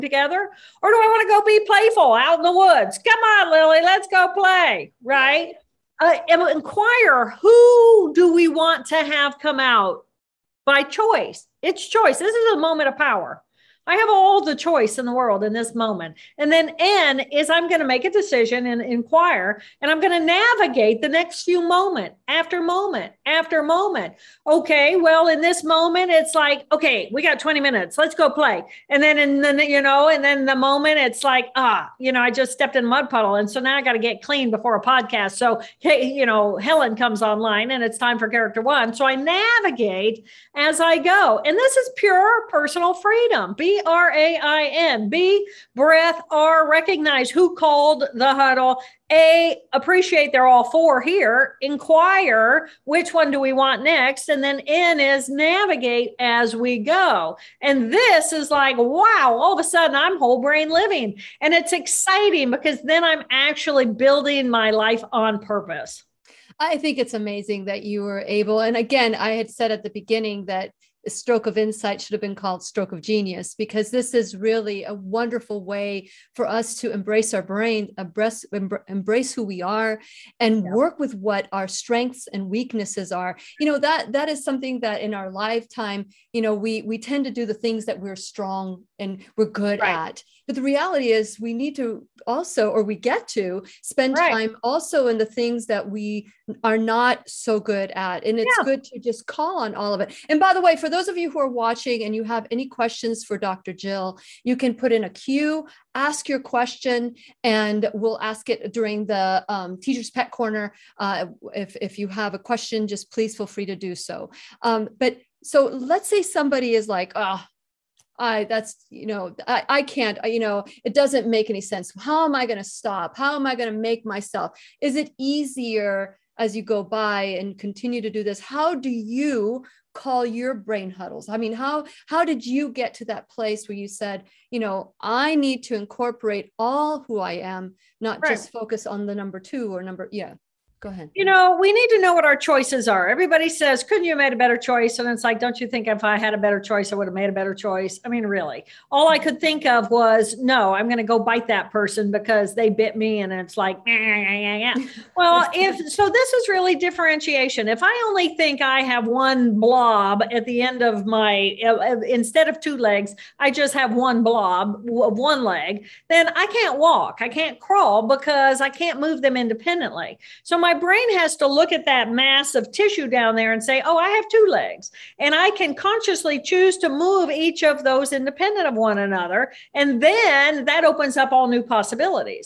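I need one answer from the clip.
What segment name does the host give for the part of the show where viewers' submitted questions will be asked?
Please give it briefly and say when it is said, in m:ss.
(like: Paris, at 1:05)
Teacher's Pet Corner, at 1:49.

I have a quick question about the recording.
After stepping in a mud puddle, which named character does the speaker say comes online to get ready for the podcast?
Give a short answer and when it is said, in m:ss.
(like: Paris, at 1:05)
Helen, at 0:36.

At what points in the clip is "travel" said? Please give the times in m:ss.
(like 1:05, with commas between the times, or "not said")
not said.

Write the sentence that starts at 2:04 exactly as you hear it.
Is it easier as you go by and continue to do this?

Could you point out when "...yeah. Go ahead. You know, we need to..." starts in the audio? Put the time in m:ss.
2:20.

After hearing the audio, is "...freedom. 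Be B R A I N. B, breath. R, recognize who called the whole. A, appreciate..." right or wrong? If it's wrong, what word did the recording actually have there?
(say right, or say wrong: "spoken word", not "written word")
wrong: "huddle", not "whole".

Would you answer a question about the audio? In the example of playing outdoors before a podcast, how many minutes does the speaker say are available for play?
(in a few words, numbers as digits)
20.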